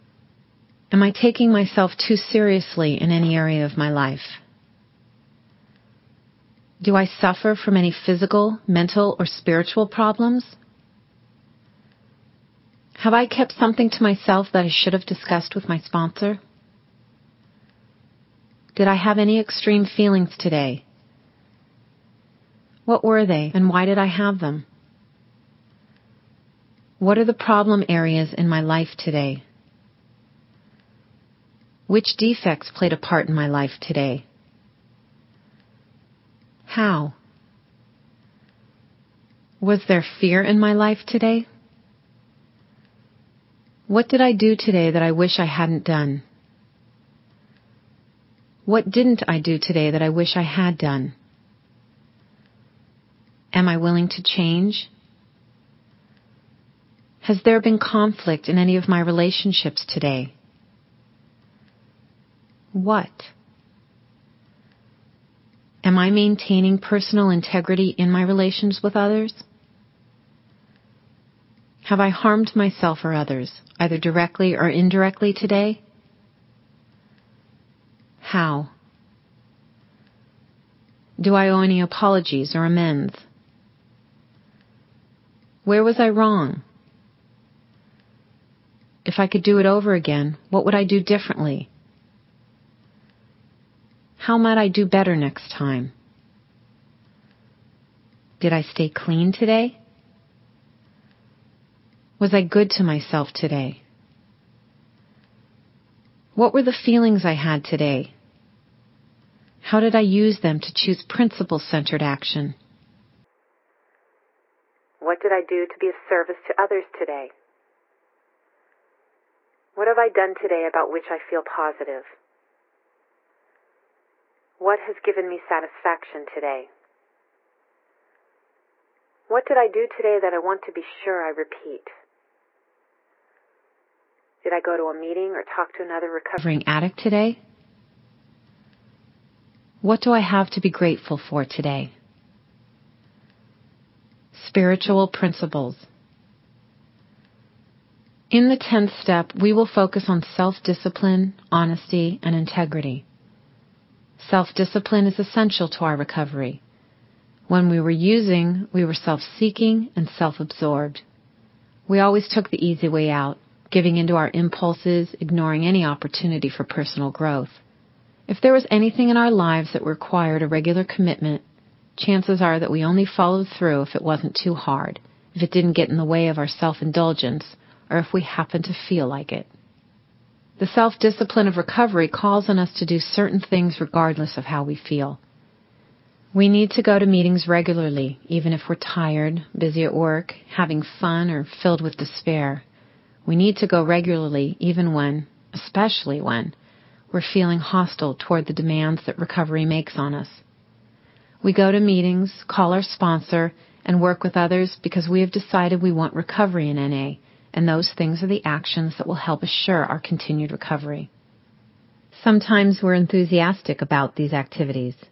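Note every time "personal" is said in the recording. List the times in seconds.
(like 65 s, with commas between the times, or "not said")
66 s, 166 s.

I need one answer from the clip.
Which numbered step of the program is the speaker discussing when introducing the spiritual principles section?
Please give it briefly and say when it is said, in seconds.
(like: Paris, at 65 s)
10th step, at 148 s.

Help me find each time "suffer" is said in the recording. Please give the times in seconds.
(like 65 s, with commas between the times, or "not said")
7 s.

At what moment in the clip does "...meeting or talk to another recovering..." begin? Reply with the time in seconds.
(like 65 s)
134 s.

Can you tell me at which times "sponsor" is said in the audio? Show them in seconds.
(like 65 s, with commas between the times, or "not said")
15 s, 202 s.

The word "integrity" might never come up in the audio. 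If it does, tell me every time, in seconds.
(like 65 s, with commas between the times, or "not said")
67 s, 152 s.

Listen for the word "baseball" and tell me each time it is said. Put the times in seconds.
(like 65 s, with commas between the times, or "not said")
not said.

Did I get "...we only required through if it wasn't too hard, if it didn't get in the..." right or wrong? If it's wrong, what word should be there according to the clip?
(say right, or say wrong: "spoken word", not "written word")
wrong: "followed", not "required".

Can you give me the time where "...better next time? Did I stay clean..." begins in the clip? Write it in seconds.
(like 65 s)
94 s.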